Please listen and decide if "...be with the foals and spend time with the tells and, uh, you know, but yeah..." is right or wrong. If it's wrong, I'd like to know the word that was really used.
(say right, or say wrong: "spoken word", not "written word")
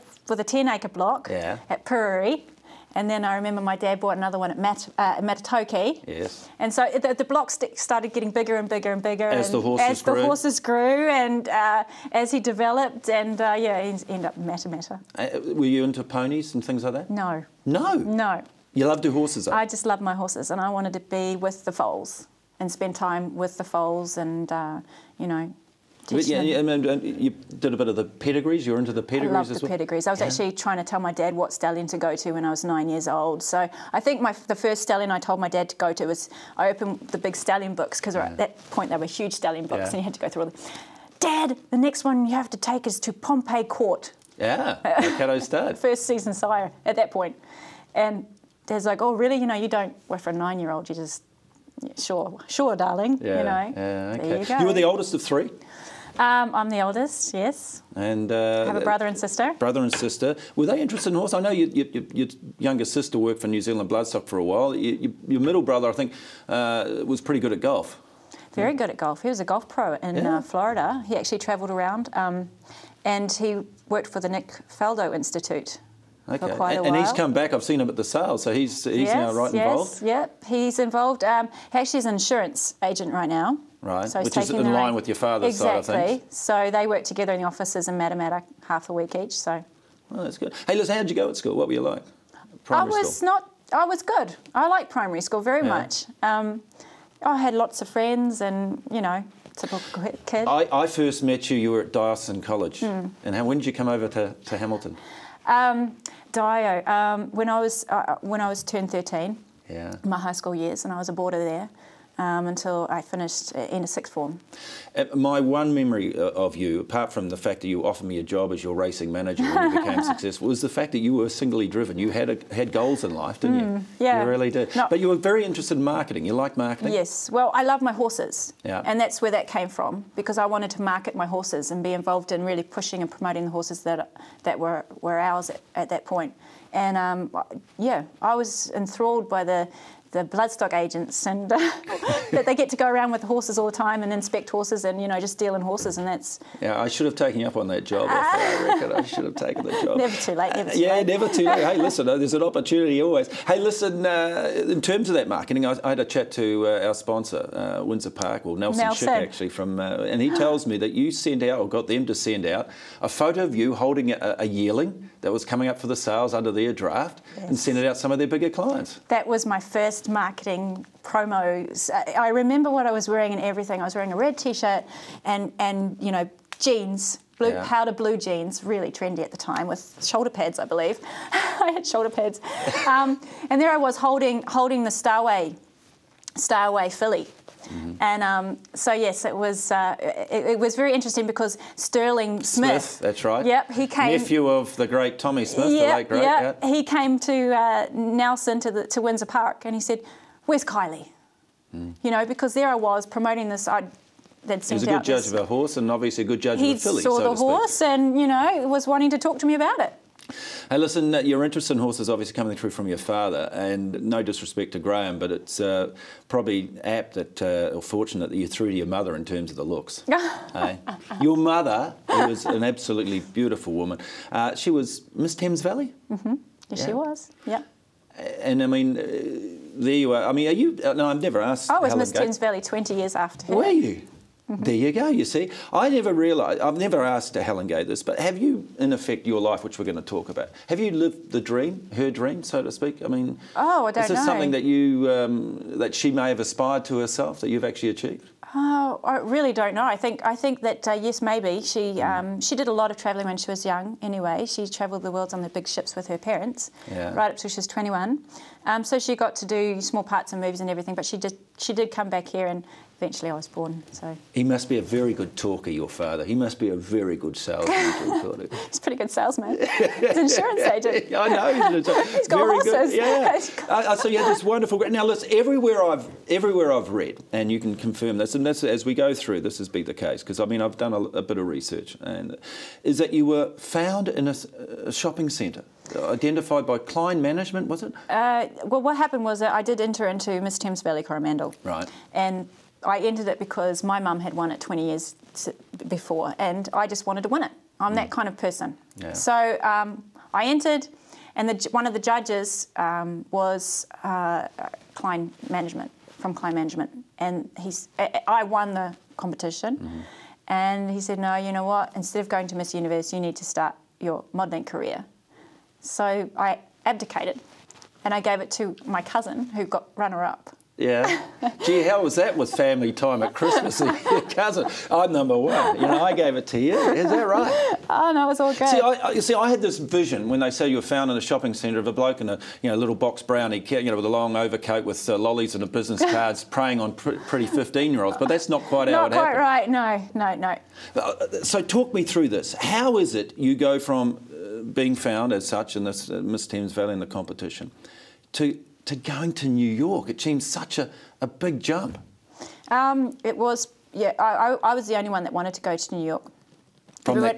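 wrong: "foals", not "tells".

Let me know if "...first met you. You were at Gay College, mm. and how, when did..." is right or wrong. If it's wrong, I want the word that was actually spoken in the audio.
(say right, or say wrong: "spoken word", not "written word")
wrong: "Dyson", not "Gay".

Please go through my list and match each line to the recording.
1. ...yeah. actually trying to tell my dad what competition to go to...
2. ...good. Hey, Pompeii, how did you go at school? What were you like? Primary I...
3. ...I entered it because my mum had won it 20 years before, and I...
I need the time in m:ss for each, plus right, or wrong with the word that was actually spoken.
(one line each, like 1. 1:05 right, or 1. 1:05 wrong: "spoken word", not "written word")
1. 0:30 wrong: "stallion", not "competition"
2. 1:30 wrong: "Liz", not "Pompeii"
3. 4:52 right.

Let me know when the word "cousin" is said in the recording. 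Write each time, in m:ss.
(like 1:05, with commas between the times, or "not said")
5:19, 5:24.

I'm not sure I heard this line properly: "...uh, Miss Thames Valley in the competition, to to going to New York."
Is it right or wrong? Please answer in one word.
right.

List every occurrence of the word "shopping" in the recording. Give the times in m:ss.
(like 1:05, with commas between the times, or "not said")
4:44, 5:31.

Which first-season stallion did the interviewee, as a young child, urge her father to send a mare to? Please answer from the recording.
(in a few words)
Pompeii Court.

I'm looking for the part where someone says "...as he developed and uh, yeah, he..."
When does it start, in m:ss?
0:12.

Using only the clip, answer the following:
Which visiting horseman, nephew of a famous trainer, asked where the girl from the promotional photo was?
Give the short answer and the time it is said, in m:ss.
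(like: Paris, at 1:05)
Sterling Smith, at 3:11.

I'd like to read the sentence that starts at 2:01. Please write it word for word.
You had a, had goals in life, didn't mm, you?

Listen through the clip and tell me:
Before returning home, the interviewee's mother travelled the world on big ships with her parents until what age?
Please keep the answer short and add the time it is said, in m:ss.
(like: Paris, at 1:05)
21, at 4:17.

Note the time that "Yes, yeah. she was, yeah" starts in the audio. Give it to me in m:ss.
3:46.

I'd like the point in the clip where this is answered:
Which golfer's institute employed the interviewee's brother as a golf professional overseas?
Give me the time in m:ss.
1:14.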